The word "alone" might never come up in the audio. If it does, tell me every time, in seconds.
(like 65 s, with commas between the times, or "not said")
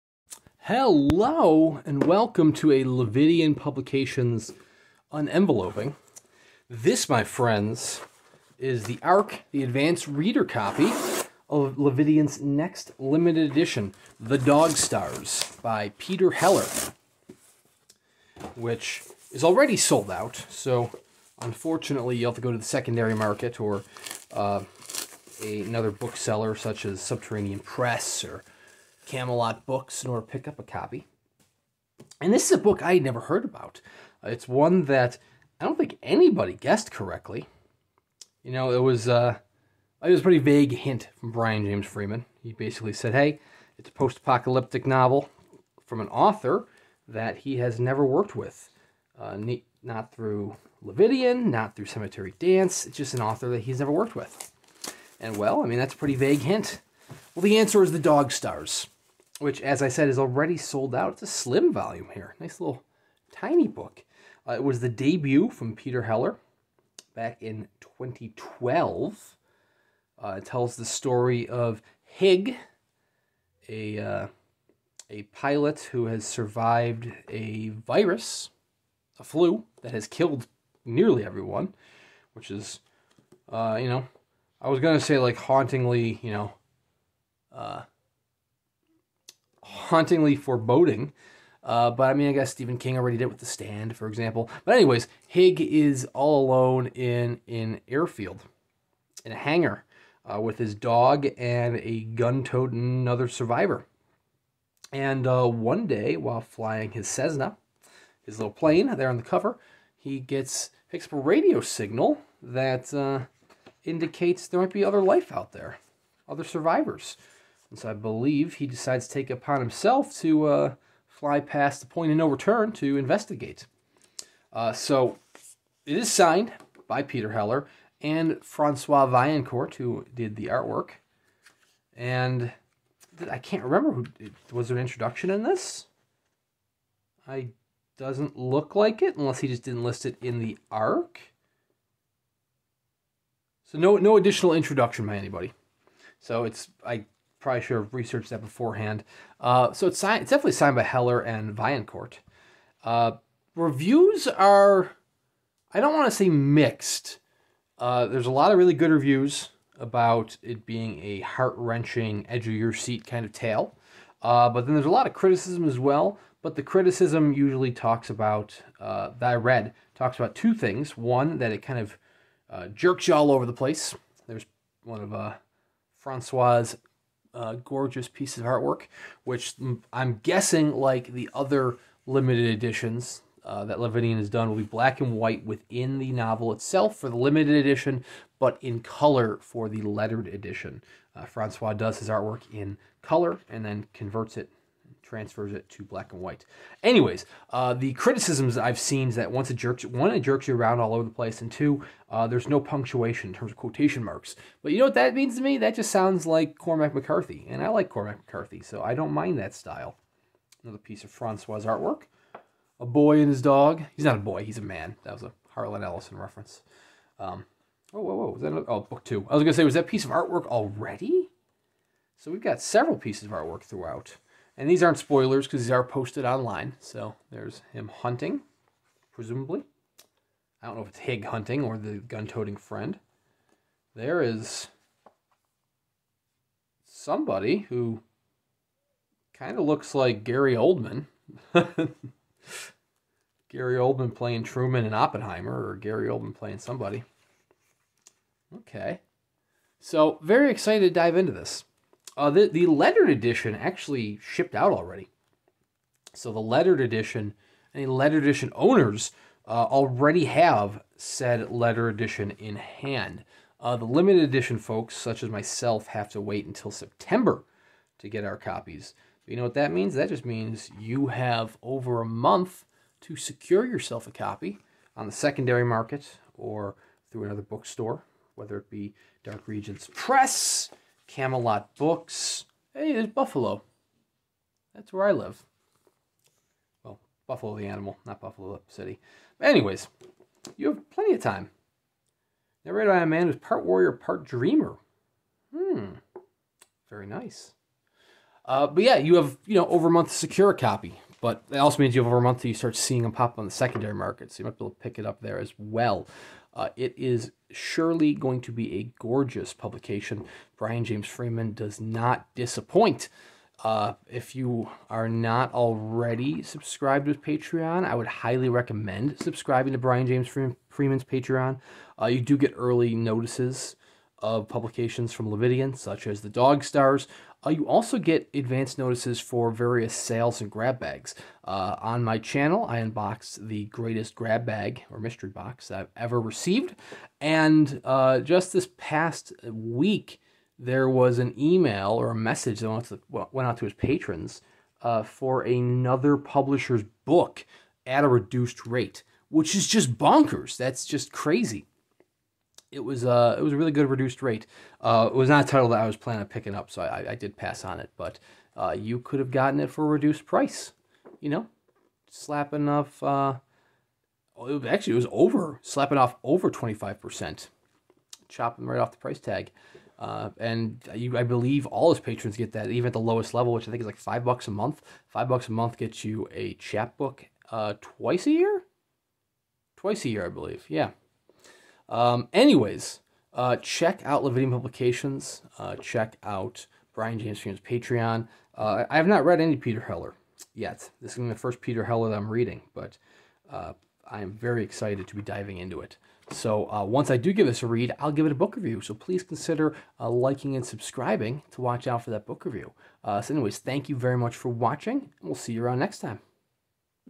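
96 s.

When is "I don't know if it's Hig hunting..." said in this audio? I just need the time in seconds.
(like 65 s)
230 s.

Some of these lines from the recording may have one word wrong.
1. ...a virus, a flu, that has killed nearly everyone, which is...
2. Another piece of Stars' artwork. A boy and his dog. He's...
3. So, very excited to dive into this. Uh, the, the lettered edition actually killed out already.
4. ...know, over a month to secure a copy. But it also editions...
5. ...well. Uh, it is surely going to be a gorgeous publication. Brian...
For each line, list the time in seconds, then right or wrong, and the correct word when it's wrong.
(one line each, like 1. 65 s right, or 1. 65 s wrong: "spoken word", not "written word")
1. 77 s right
2. 210 s wrong: "Francois", not "Stars"
3. 249 s wrong: "shipped", not "killed"
4. 299 s wrong: "means", not "editions"
5. 305 s right.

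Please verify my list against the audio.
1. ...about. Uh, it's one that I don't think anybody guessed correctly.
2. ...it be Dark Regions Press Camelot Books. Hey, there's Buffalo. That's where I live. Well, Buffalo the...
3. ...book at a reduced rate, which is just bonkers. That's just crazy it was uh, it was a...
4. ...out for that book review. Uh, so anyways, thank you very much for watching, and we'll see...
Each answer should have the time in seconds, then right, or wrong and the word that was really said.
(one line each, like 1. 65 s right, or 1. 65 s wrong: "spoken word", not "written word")
1. 33 s right
2. 278 s right
3. 347 s right
4. 401 s right.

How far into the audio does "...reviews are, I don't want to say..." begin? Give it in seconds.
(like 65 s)
153 s.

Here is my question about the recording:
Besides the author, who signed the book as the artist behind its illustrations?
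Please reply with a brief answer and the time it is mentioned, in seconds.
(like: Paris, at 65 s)
Francois Vaillancourt, at 128 s.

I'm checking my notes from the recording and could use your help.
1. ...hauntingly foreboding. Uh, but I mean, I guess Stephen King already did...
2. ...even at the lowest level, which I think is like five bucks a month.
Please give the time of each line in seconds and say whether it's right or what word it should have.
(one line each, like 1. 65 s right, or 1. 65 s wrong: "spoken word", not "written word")
1. 89 s right
2. 372 s right.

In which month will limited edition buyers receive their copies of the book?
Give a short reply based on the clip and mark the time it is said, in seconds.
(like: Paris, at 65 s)
September, at 266 s.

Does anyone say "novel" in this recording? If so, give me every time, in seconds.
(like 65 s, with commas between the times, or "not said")
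44 s, 186 s.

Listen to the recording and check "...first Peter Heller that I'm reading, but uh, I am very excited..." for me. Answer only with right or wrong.
right.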